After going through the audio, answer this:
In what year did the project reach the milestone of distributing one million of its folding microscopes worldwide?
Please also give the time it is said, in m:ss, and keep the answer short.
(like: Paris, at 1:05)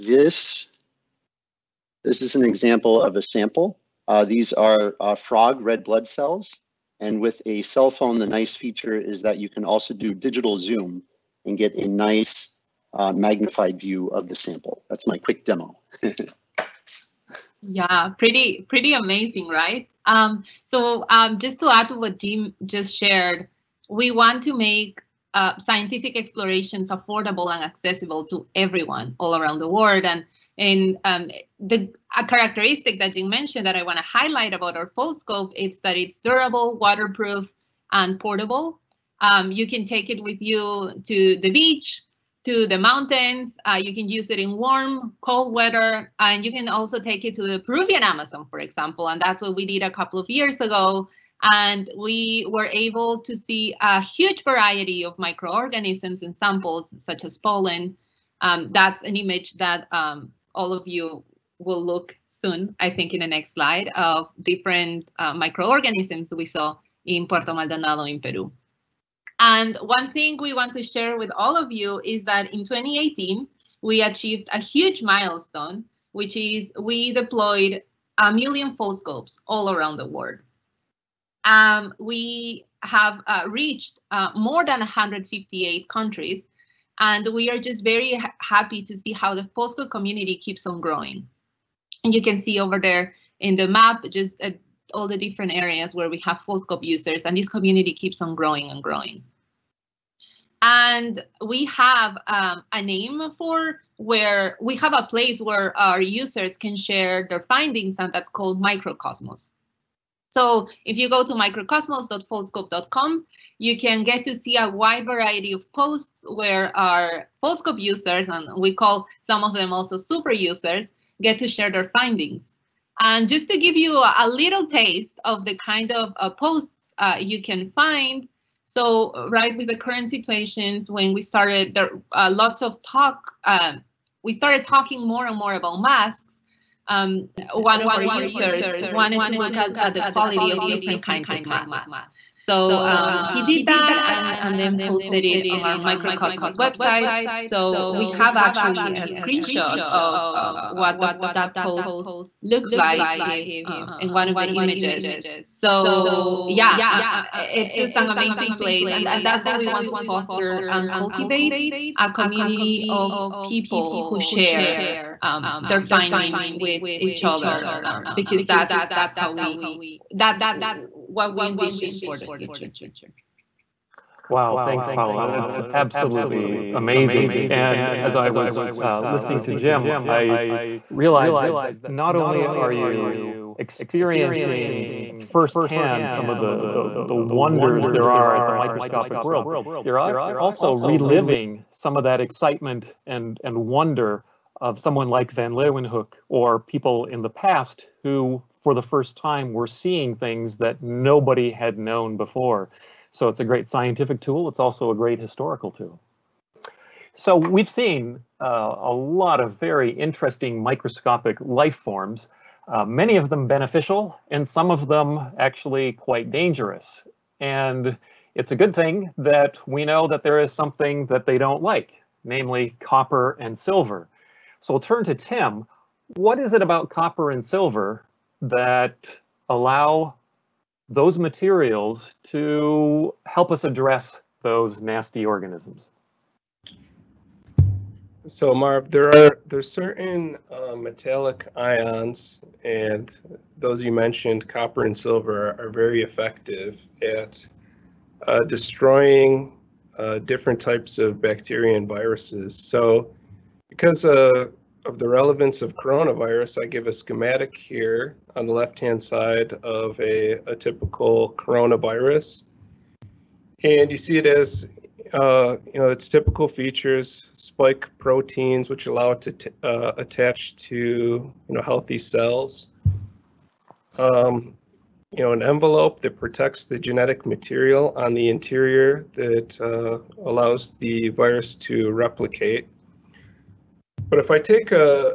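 2018, at 1:12.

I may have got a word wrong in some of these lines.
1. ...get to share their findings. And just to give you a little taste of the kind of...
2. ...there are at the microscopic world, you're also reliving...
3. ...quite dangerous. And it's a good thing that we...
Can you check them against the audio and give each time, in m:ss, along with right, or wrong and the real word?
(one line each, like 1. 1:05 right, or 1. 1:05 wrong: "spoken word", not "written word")
1. 2:01 right
2. 3:07 right
3. 3:35 right.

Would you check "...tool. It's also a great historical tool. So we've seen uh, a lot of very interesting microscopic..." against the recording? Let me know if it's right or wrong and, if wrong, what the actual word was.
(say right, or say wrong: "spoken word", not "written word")
right.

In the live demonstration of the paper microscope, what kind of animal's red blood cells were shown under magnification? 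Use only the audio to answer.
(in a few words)
Frog.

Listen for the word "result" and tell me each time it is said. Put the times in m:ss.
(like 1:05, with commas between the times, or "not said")
not said.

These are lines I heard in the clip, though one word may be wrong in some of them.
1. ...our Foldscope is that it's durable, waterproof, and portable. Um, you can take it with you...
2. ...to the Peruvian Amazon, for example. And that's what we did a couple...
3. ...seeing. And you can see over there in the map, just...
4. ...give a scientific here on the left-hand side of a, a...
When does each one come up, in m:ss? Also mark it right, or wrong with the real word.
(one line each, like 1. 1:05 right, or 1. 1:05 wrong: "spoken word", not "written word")
1. 0:34 right
2. 0:47 right
3. 1:30 wrong: "growing", not "seeing"
4. 4:16 wrong: "schematic", not "scientific".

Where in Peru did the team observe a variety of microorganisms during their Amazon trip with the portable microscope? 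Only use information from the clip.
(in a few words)
Puerto Maldonado.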